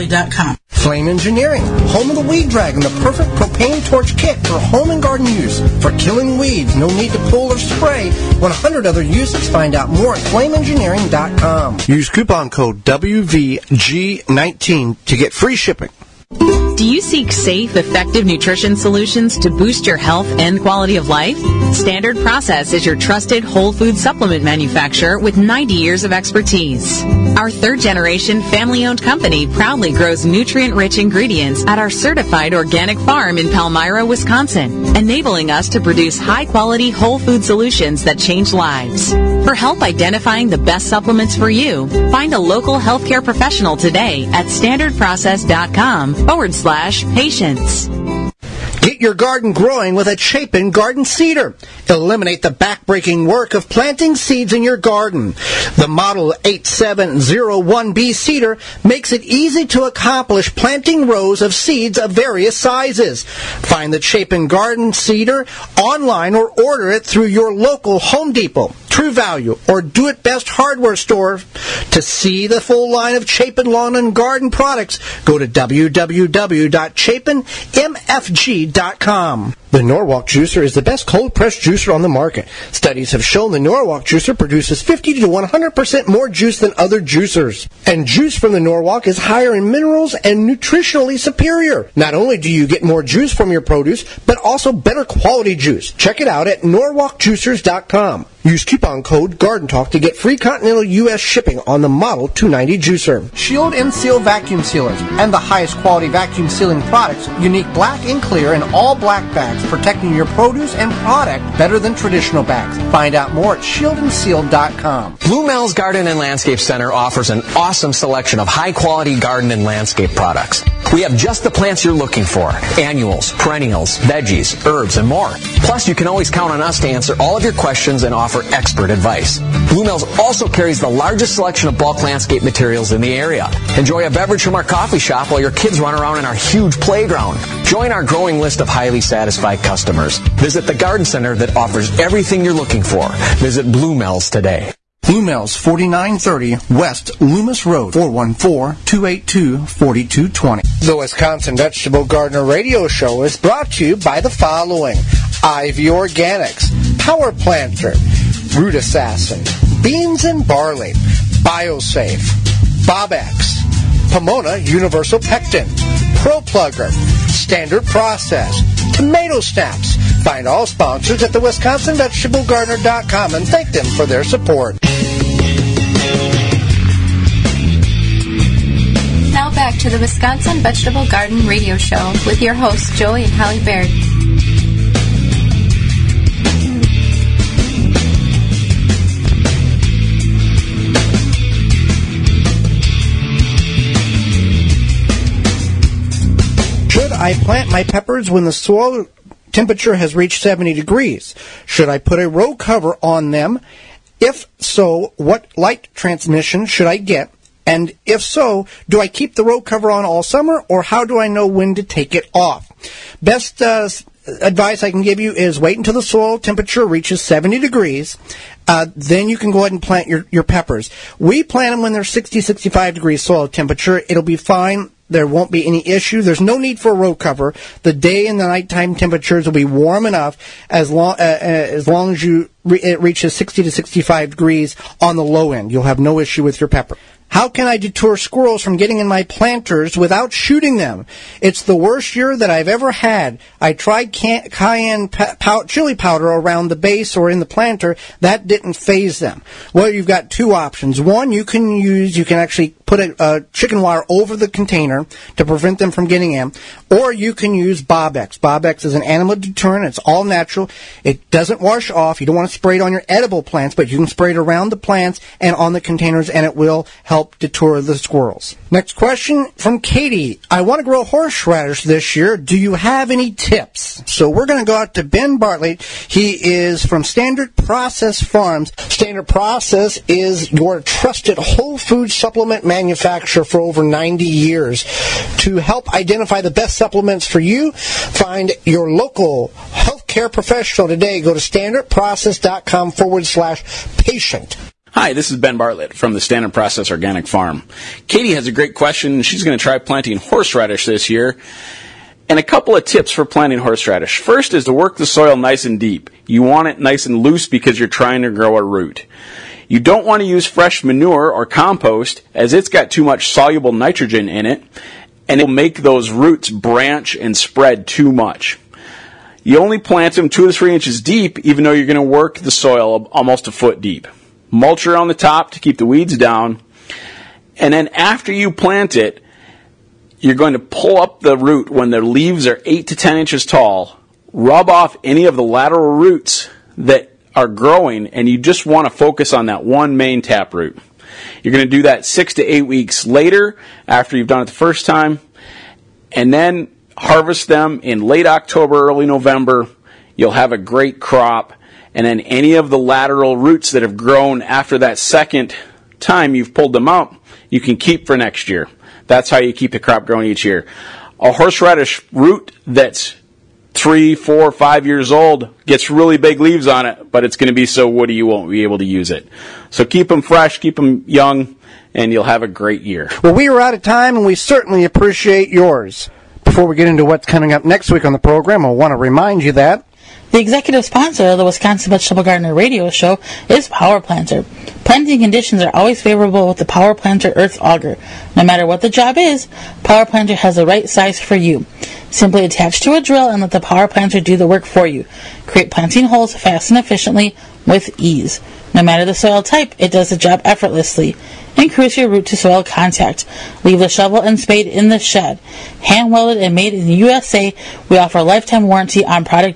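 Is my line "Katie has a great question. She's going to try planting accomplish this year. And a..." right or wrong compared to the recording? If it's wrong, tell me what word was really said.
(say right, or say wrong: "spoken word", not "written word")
wrong: "horseradish", not "accomplish".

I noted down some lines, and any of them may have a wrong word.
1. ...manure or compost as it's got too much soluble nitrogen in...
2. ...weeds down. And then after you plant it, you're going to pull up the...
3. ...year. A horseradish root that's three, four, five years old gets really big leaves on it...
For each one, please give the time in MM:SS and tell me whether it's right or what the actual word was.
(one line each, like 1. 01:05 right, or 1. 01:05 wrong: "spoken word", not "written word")
1. 05:10 right
2. 05:25 right
3. 06:00 right.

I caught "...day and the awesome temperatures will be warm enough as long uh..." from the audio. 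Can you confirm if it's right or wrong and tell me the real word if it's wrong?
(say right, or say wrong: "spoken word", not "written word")
wrong: "nighttime", not "awesome".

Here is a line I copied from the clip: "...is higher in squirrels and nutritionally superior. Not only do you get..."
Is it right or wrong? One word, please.
wrong.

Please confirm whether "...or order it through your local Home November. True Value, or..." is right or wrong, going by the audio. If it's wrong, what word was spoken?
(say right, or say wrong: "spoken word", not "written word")
wrong: "Depot", not "November".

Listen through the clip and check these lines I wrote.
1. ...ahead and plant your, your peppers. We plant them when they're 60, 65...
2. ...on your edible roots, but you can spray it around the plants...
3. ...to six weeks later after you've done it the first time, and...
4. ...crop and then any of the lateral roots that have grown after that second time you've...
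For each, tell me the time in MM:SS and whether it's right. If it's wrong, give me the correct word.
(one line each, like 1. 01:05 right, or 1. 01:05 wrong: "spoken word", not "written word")
1. 03:39 right
2. 04:22 wrong: "plants", not "roots"
3. 05:42 wrong: "eight", not "six"
4. 05:50 right.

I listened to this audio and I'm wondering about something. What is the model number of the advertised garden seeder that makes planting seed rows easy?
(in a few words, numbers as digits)
8701B.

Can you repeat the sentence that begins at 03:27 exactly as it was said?
And if so, do I keep the row cover on all summer or how do I know when to take it off?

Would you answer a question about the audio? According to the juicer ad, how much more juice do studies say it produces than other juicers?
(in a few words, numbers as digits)
50 to 100%.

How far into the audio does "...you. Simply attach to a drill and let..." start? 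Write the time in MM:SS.
06:31.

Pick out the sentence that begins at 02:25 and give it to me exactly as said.
Bluemel's 4930 West Loomis Road, 414-282-4220.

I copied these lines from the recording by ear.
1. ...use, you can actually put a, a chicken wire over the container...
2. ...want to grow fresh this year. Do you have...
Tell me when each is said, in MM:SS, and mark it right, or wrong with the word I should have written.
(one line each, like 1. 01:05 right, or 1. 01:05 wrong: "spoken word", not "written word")
1. 04:11 right
2. 04:30 wrong: "horseradish", not "fresh".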